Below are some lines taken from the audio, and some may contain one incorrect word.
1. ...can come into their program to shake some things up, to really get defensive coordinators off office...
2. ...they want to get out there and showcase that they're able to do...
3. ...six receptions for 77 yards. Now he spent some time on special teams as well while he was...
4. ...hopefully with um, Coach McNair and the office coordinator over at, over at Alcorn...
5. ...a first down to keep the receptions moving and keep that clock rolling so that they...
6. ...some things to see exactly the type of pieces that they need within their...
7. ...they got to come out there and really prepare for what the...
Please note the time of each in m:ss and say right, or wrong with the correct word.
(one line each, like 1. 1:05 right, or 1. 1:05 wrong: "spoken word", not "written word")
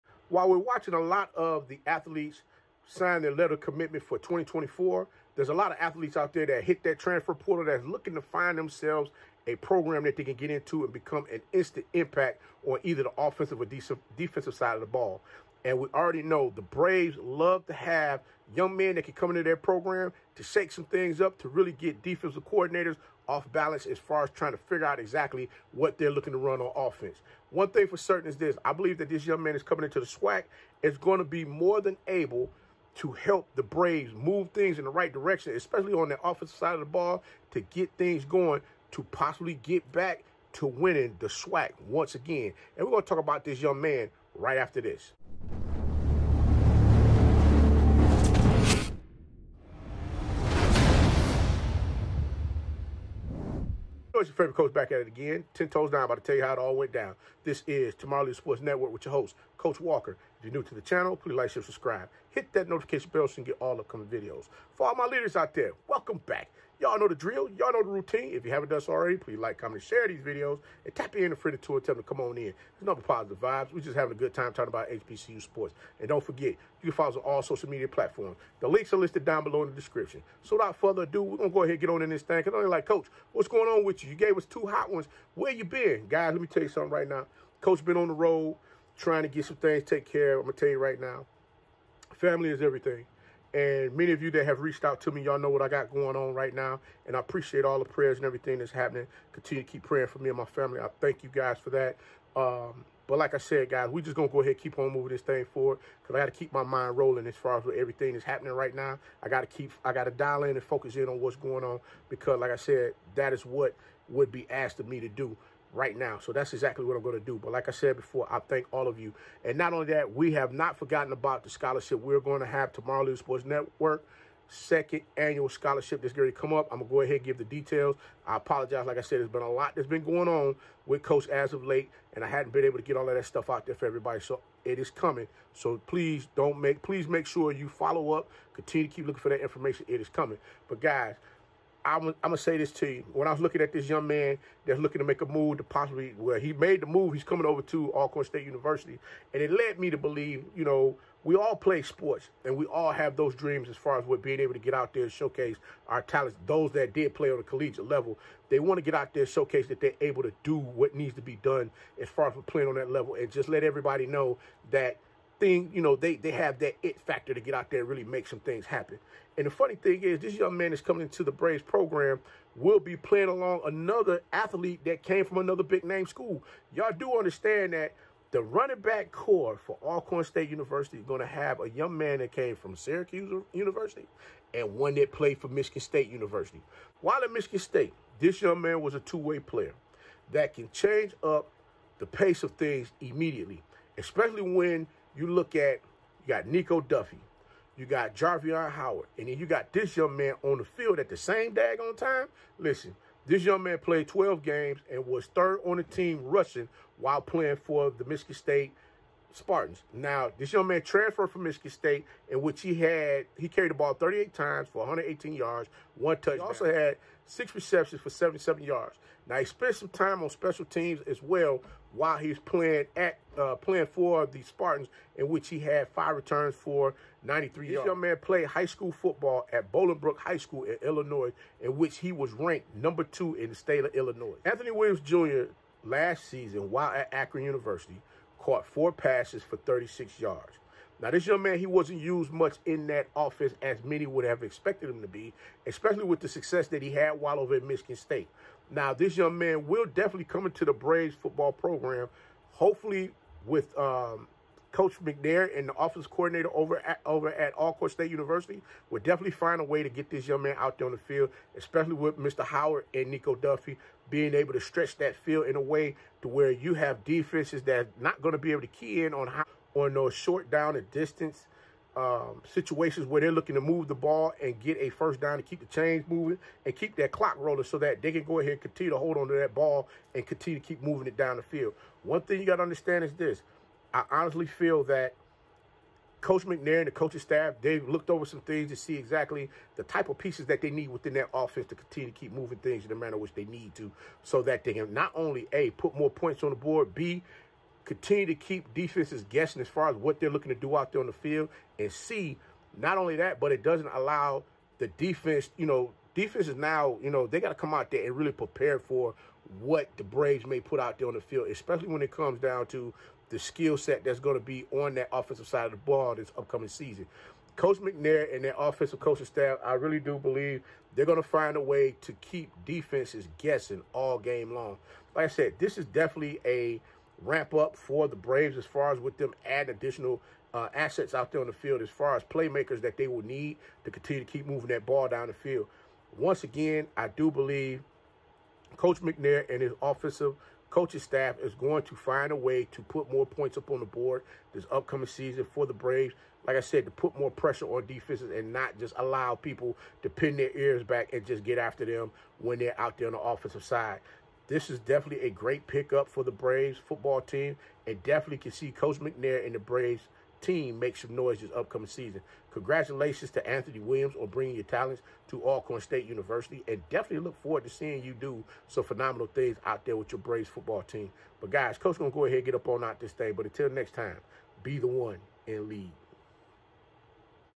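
1. 0:19 wrong: "balance", not "office"
2. 2:38 right
3. 3:37 right
4. 4:12 right
5. 4:34 wrong: "chains", not "receptions"
6. 4:48 right
7. 5:07 right.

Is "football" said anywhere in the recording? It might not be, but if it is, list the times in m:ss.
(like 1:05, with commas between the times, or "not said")
3:48, 4:11, 5:56, 6:10.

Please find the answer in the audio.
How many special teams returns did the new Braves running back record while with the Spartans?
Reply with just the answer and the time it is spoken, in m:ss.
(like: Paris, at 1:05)
5, at 3:45.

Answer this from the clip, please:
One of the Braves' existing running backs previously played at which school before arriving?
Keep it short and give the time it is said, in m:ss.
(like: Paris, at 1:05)
Syracuse University, at 3:02.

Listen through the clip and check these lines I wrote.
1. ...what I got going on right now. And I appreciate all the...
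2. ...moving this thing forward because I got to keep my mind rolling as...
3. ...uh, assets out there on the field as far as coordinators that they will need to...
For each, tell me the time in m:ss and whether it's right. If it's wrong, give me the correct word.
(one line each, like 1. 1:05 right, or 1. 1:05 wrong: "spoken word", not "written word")
1. 1:35 right
2. 1:44 right
3. 5:30 wrong: "playmakers", not "coordinators".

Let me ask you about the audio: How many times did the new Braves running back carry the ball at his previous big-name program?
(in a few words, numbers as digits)
38.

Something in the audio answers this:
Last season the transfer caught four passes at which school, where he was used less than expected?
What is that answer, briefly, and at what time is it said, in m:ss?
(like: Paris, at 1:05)
Akron University, at 3:57.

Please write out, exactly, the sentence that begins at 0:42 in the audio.
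And we're going to talk about this young man right after this.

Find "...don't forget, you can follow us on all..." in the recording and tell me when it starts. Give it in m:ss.
1:16.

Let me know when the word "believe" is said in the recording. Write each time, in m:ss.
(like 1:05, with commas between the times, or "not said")
0:28, 2:29, 5:20, 5:37.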